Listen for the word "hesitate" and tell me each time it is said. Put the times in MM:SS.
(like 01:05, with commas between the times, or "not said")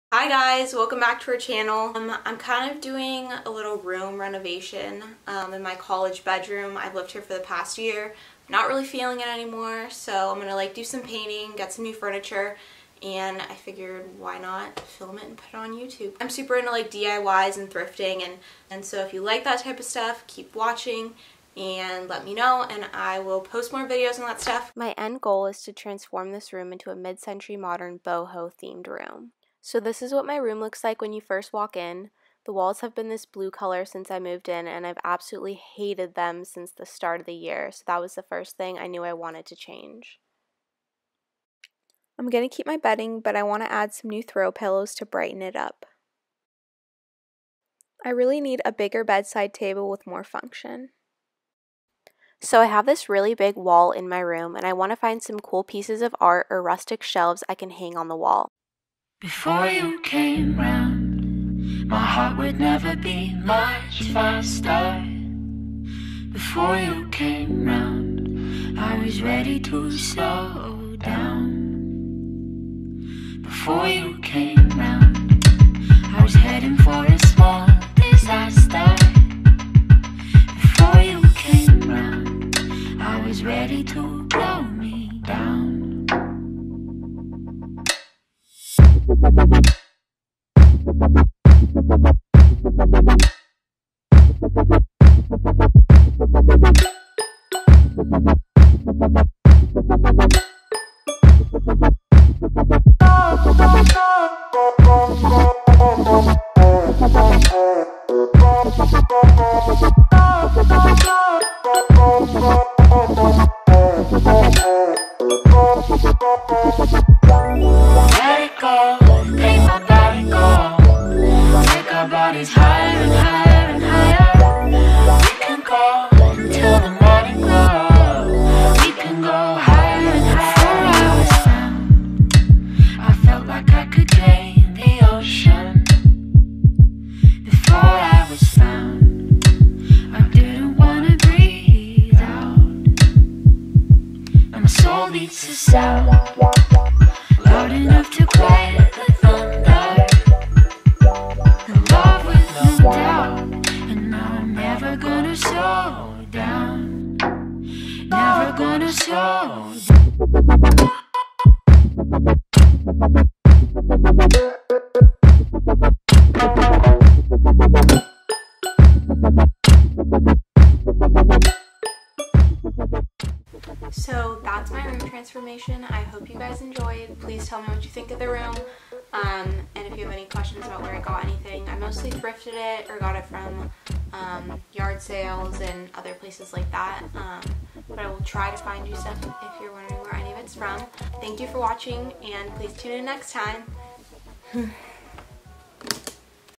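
not said.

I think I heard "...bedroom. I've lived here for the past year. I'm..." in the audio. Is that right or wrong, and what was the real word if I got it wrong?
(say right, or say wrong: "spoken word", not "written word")
right.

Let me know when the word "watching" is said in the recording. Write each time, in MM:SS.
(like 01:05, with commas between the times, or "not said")
00:20, 03:11.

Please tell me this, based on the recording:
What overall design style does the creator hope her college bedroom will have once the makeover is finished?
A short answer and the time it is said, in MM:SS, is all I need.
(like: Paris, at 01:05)
mid-century modern boho, at 00:26.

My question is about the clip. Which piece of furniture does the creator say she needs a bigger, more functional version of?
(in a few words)
bedside table.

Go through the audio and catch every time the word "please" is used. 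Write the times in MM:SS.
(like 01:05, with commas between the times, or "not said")
02:57, 03:12.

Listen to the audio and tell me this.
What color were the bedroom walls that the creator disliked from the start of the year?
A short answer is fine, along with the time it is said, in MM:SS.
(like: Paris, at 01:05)
blue, at 00:33.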